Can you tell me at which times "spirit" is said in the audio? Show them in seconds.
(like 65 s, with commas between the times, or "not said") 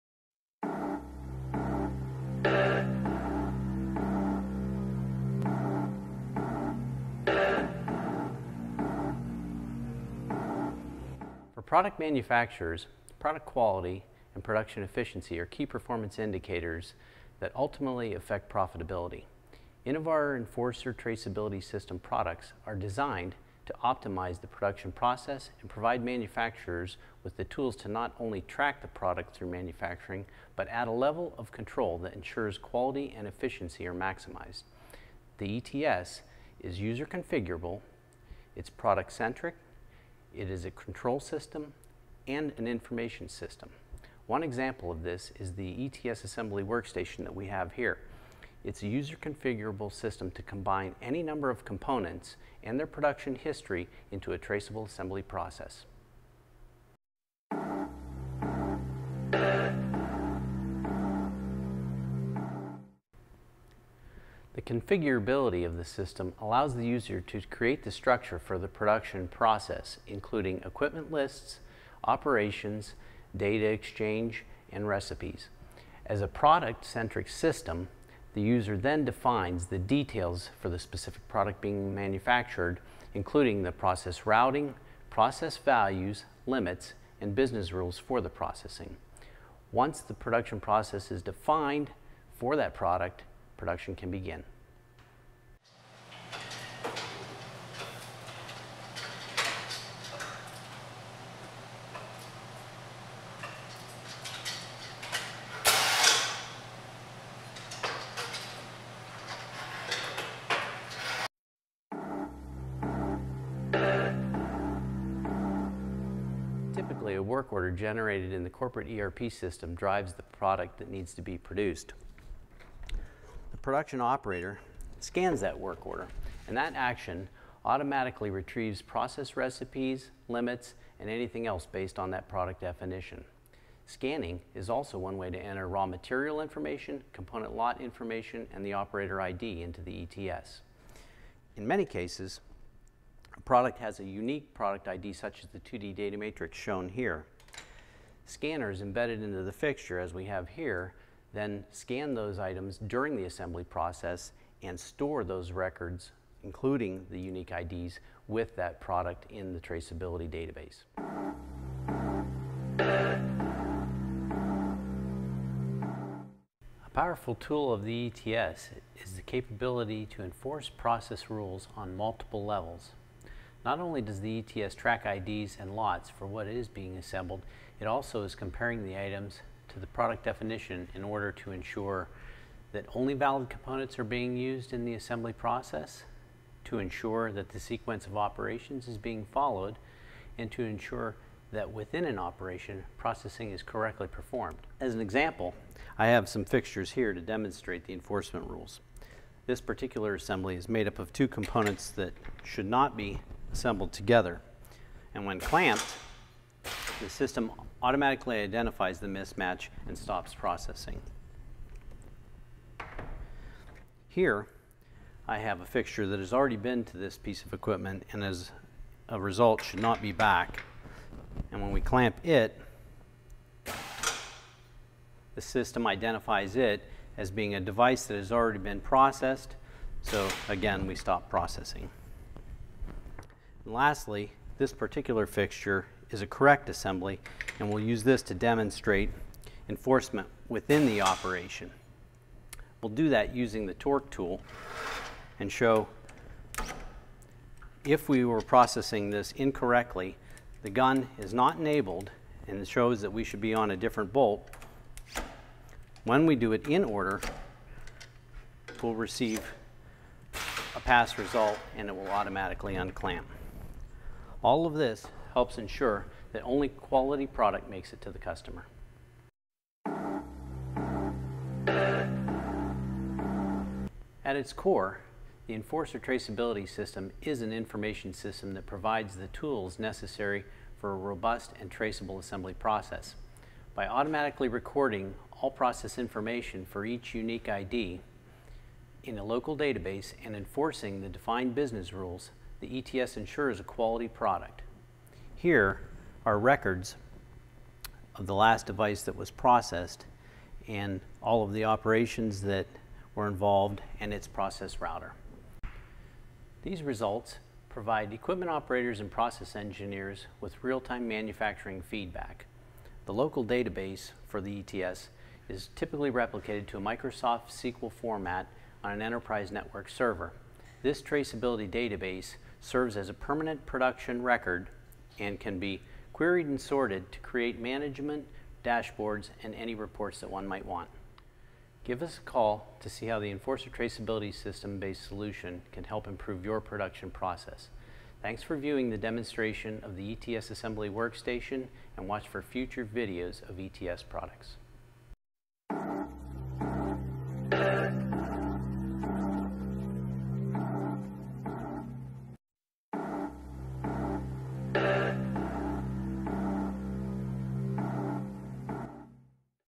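not said.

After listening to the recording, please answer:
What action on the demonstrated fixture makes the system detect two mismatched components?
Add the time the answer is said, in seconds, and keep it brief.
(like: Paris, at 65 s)
clamped, at 205 s.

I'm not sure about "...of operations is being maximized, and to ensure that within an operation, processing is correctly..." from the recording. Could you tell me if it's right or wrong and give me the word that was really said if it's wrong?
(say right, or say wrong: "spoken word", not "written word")
wrong: "followed", not "maximized".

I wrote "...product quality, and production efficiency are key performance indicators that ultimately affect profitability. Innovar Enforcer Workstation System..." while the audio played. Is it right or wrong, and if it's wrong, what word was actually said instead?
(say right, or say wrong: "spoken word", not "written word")
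wrong: "Traceability", not "Workstation".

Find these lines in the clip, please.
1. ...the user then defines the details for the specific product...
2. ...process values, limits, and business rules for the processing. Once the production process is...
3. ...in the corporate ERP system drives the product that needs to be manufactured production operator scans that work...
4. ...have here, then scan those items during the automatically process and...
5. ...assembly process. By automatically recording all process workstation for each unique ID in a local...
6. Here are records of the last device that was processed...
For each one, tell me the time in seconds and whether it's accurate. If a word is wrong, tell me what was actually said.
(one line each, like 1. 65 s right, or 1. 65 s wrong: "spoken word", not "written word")
1. 78 s right
2. 85 s right
3. 118 s wrong: "produced", not "manufactured"
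4. 150 s wrong: "assembly", not "automatically"
5. 282 s wrong: "information", not "workstation"
6. 295 s right.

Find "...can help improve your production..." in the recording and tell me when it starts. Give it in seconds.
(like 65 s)
335 s.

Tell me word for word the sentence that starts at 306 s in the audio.
These results provide equipment operators and process engineers with real-time manufacturing feedback.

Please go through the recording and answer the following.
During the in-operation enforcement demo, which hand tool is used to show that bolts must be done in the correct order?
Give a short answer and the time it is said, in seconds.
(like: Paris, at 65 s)
torque tool, at 243 s.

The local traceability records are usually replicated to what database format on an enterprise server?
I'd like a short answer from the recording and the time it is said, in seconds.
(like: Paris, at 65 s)
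Microsoft SQL, at 316 s.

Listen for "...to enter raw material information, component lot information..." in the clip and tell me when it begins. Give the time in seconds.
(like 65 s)
135 s.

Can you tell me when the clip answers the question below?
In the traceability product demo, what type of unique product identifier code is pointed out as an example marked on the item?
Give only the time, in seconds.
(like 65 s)
145 s.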